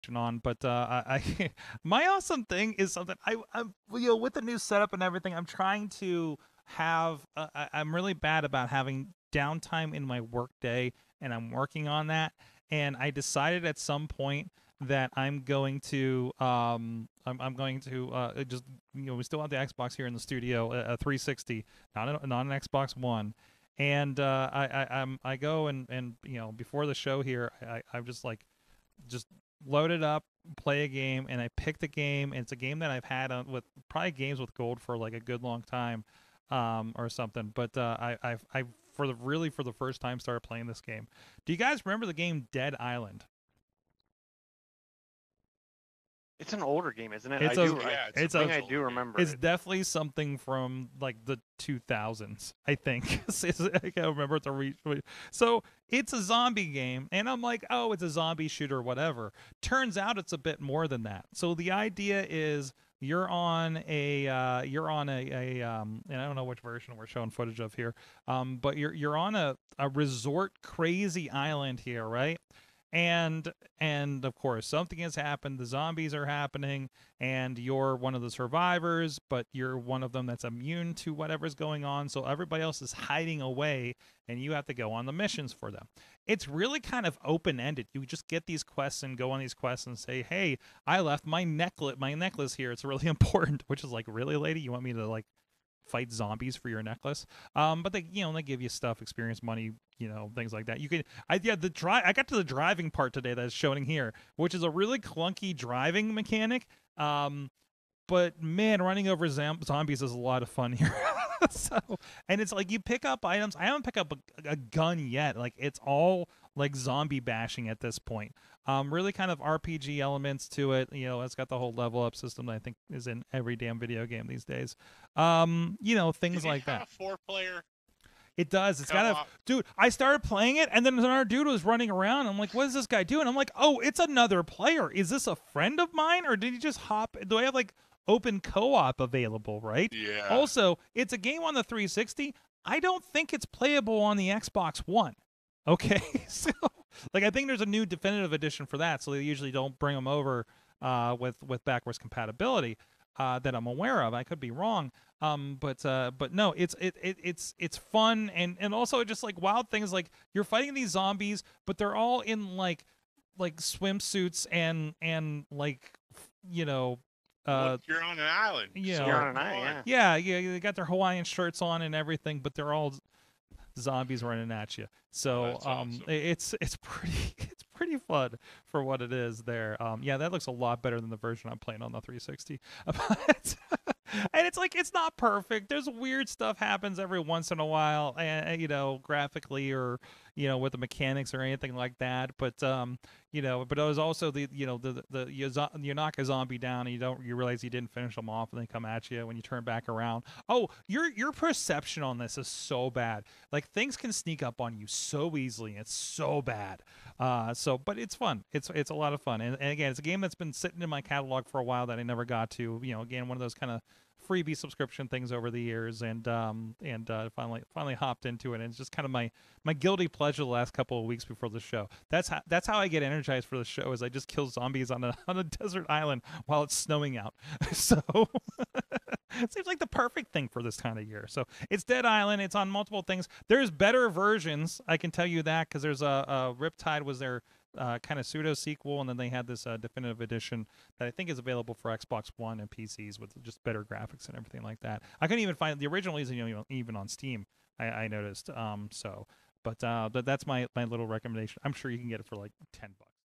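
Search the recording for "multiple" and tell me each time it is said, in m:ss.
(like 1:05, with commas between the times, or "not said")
3:52.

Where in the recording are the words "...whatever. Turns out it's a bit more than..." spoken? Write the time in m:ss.
0:58.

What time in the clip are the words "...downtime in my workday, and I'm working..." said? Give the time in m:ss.
0:09.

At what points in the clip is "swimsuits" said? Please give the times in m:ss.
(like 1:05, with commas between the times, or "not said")
2:43.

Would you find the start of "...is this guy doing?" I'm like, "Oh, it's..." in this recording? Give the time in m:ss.
2:12.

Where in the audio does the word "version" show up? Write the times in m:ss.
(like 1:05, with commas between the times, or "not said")
1:06, 3:01, 3:54.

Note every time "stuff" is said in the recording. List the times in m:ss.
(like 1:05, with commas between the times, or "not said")
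1:38, 3:06.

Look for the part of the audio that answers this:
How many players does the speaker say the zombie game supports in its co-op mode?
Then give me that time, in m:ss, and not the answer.
2:06.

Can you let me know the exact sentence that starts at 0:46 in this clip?
It's an older game, isn't it?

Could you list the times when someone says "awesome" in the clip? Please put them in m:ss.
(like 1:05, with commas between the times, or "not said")
0:02, 2:55.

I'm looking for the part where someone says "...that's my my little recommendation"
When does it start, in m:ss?
4:10.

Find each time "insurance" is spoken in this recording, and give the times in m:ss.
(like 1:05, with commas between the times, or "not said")
not said.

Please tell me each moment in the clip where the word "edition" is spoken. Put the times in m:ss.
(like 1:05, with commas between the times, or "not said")
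2:28, 4:00.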